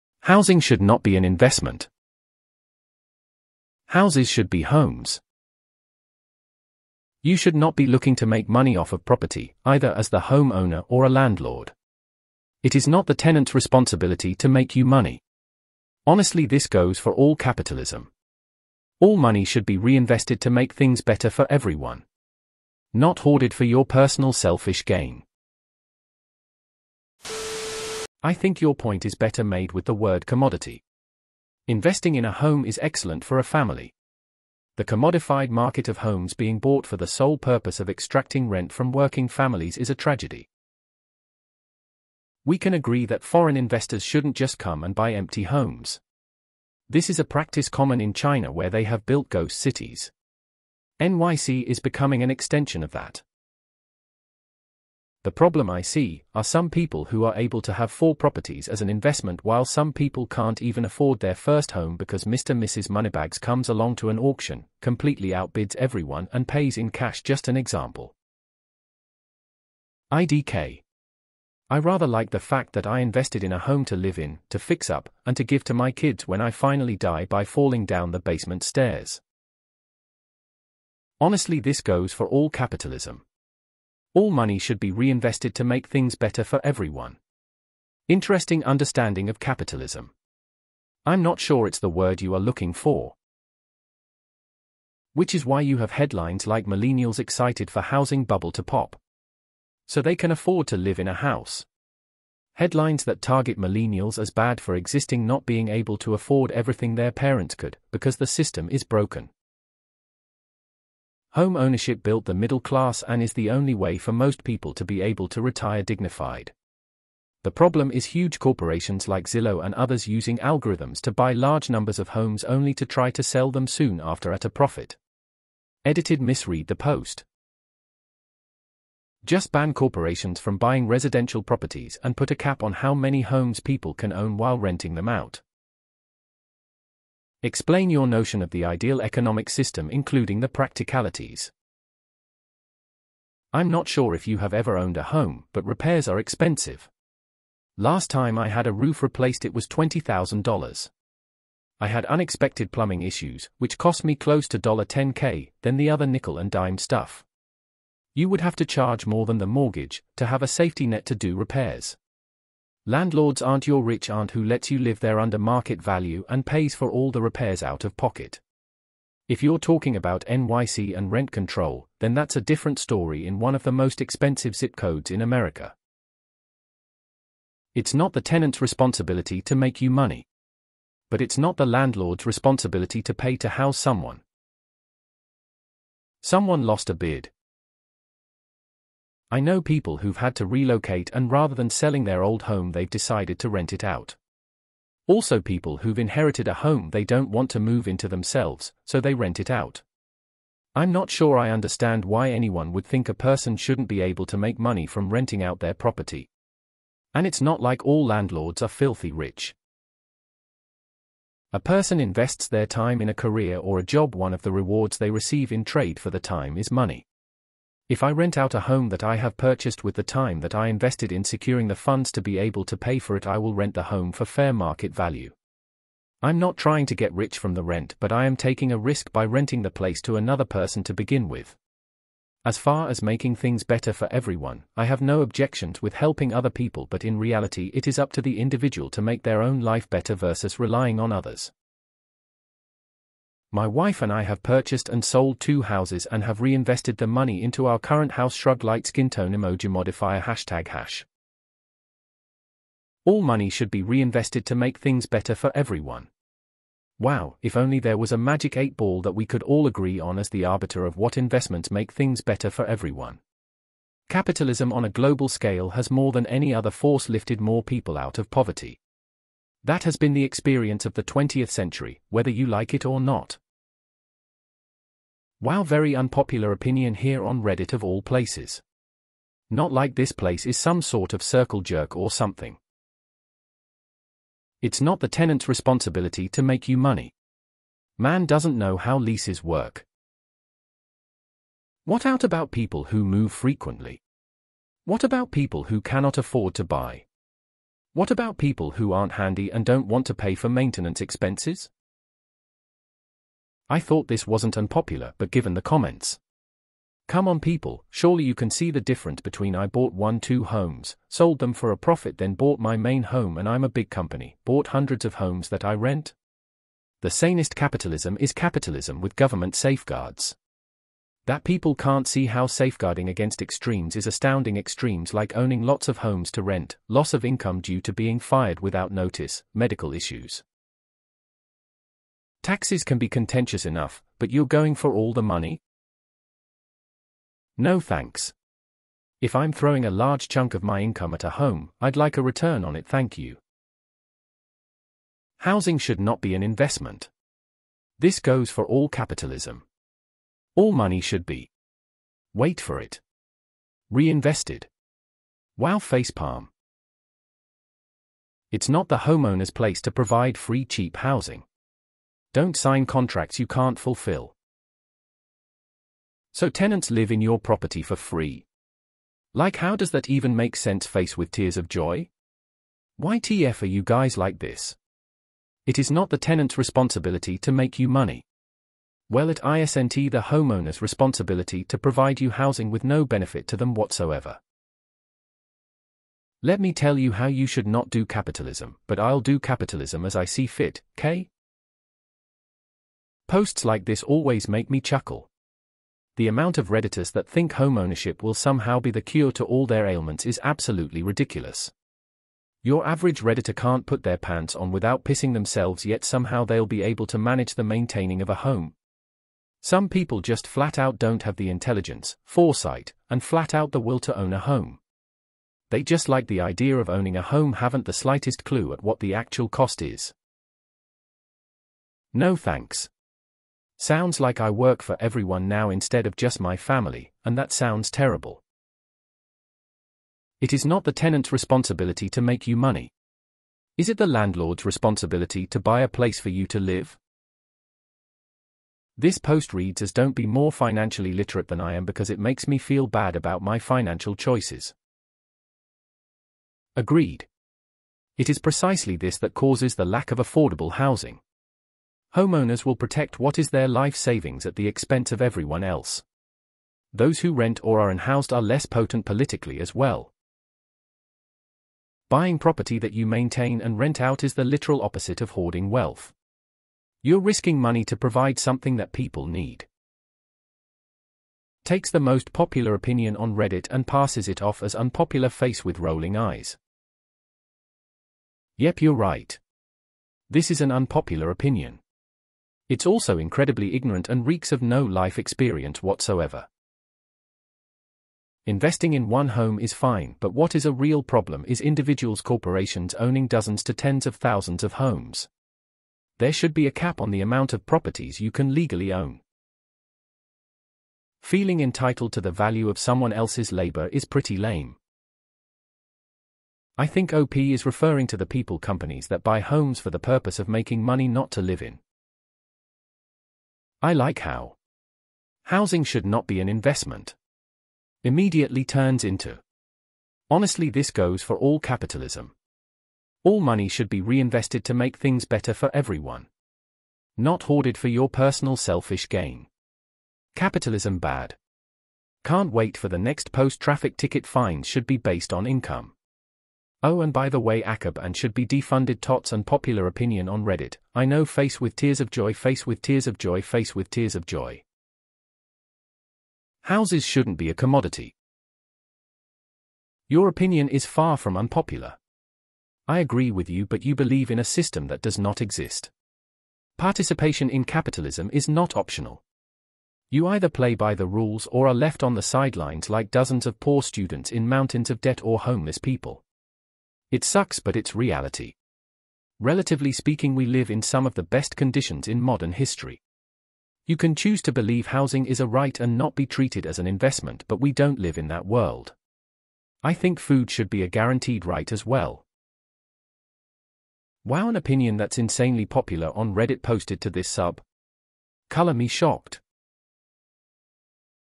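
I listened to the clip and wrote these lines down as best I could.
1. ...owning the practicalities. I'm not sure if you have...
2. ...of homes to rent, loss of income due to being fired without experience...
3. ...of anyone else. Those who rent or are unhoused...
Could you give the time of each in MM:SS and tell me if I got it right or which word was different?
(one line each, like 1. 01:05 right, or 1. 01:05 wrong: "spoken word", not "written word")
1. 02:19 wrong: "including", not "owning"
2. 05:25 wrong: "notice", not "experience"
3. 07:35 wrong: "everyone", not "anyone".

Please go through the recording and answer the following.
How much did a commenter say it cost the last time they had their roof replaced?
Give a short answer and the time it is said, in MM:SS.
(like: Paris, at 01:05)
$20,000, at 02:29.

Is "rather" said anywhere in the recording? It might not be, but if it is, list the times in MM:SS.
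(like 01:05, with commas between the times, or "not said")
01:11, 03:11.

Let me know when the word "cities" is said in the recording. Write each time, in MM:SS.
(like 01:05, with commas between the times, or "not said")
00:49.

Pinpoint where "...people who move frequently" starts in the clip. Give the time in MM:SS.
04:52.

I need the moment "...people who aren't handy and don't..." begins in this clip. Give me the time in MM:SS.
04:58.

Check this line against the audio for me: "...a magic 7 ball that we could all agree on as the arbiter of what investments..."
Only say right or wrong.
wrong.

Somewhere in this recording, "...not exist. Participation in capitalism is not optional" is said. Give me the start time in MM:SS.
09:15.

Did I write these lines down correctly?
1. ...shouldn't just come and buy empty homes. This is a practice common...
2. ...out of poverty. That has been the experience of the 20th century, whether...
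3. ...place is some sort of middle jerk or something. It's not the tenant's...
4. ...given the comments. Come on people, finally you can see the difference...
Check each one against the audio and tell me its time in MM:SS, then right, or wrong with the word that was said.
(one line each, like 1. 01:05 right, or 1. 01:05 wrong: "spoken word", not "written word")
1. 00:44 right
2. 04:27 right
3. 04:40 wrong: "circle", not "middle"
4. 05:05 wrong: "surely", not "finally".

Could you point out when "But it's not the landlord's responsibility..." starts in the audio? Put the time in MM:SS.
03:01.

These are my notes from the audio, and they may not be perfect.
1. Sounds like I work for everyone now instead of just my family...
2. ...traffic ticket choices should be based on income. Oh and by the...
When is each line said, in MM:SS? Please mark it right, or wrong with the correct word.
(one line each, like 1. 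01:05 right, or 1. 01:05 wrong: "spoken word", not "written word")
1. 07:03 right
2. 08:53 wrong: "fines", not "choices".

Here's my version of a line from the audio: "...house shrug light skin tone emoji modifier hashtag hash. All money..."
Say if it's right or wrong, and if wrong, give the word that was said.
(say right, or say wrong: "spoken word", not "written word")
right.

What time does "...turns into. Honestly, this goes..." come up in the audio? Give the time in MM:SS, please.
08:38.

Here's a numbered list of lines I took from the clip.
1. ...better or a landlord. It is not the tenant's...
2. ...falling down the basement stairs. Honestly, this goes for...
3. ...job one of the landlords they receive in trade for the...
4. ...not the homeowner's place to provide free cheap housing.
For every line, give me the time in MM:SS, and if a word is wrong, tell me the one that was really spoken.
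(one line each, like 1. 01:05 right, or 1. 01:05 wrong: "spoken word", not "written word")
1. 00:10 wrong: "homeowner", not "better"
2. 01:17 right
3. 03:33 wrong: "rewards", not "landlords"
4. 05:58 right.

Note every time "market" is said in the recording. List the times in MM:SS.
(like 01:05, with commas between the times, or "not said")
00:35, 02:45, 03:44.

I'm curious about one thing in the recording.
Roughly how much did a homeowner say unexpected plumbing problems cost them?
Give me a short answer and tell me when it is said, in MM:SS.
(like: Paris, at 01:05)
$10k, at 02:34.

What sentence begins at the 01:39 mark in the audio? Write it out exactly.
So they can afford to live in a house.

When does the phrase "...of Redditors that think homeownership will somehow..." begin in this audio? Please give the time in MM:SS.
06:36.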